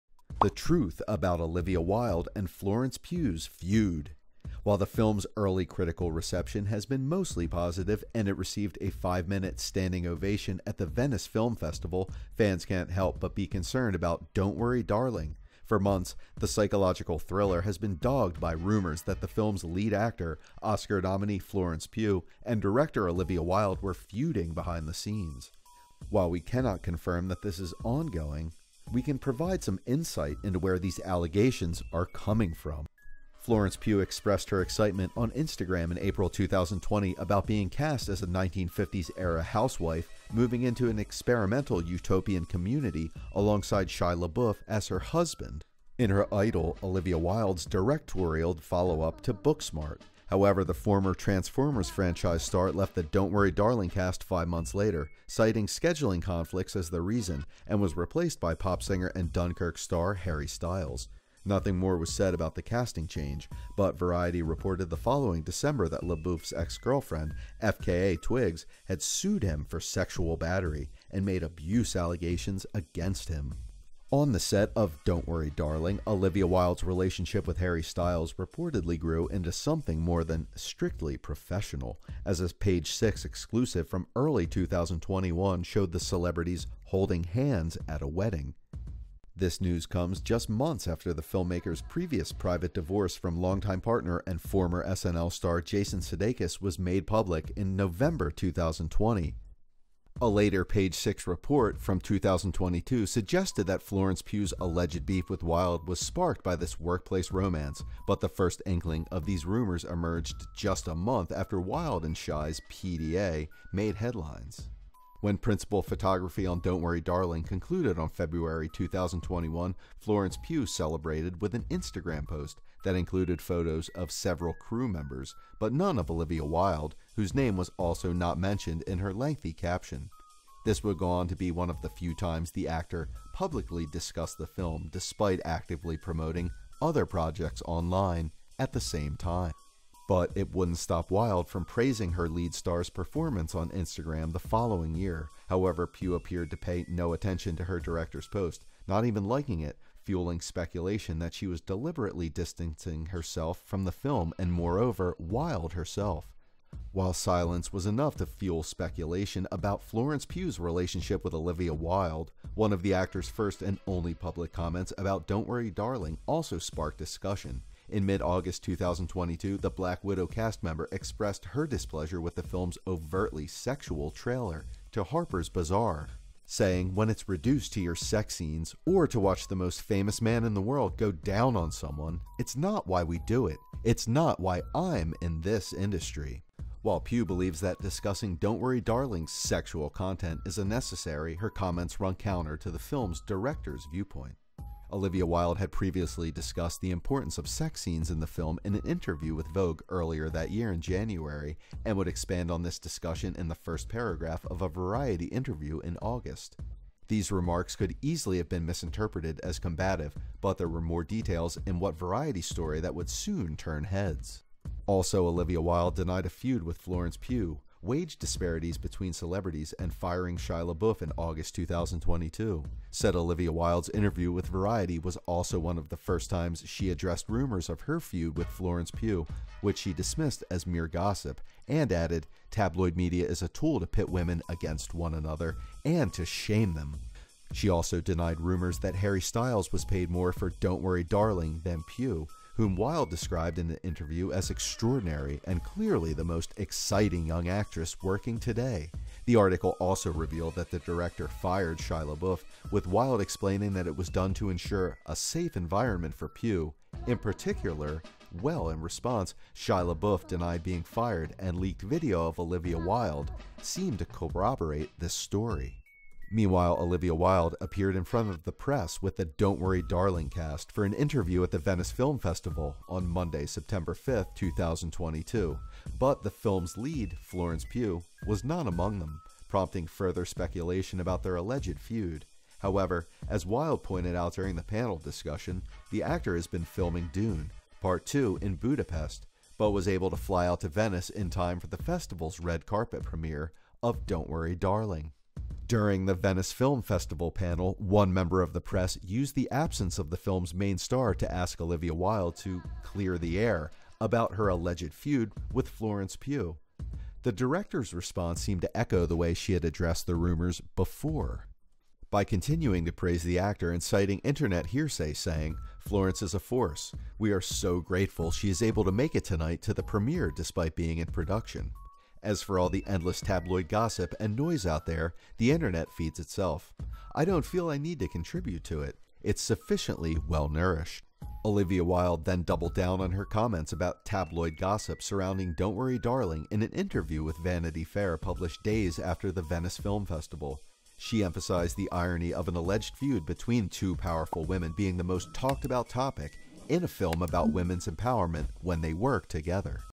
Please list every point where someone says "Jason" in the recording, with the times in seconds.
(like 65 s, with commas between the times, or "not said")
95 s.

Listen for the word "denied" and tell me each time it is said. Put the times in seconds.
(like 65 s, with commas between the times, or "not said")
215 s, 237 s, 260 s.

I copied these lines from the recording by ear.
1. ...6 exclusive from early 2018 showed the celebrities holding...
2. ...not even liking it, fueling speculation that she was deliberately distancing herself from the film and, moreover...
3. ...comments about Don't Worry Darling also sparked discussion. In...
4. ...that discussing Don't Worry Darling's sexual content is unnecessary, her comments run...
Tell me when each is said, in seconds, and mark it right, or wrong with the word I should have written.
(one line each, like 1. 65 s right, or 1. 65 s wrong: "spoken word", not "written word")
1. 82 s wrong: "2021", not "2018"
2. 148 s right
3. 164 s right
4. 187 s right.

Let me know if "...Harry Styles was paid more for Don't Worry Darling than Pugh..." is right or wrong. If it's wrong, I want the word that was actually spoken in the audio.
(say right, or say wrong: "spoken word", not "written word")
right.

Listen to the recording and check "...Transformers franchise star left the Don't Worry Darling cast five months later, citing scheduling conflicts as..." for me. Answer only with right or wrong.
right.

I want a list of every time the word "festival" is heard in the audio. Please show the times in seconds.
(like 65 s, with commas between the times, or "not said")
11 s, 272 s, 291 s, 296 s, 340 s.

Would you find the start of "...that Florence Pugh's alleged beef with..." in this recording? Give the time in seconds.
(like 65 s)
103 s.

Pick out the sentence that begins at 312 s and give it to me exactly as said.
By continuing to praise the actor and citing internet hearsay, saying, Florence is a force.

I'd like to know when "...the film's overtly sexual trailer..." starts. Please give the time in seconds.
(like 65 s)
172 s.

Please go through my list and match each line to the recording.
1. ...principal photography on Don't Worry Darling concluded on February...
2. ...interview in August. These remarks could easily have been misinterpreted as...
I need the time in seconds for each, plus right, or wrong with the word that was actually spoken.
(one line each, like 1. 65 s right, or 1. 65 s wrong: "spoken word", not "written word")
1. 115 s right
2. 205 s right.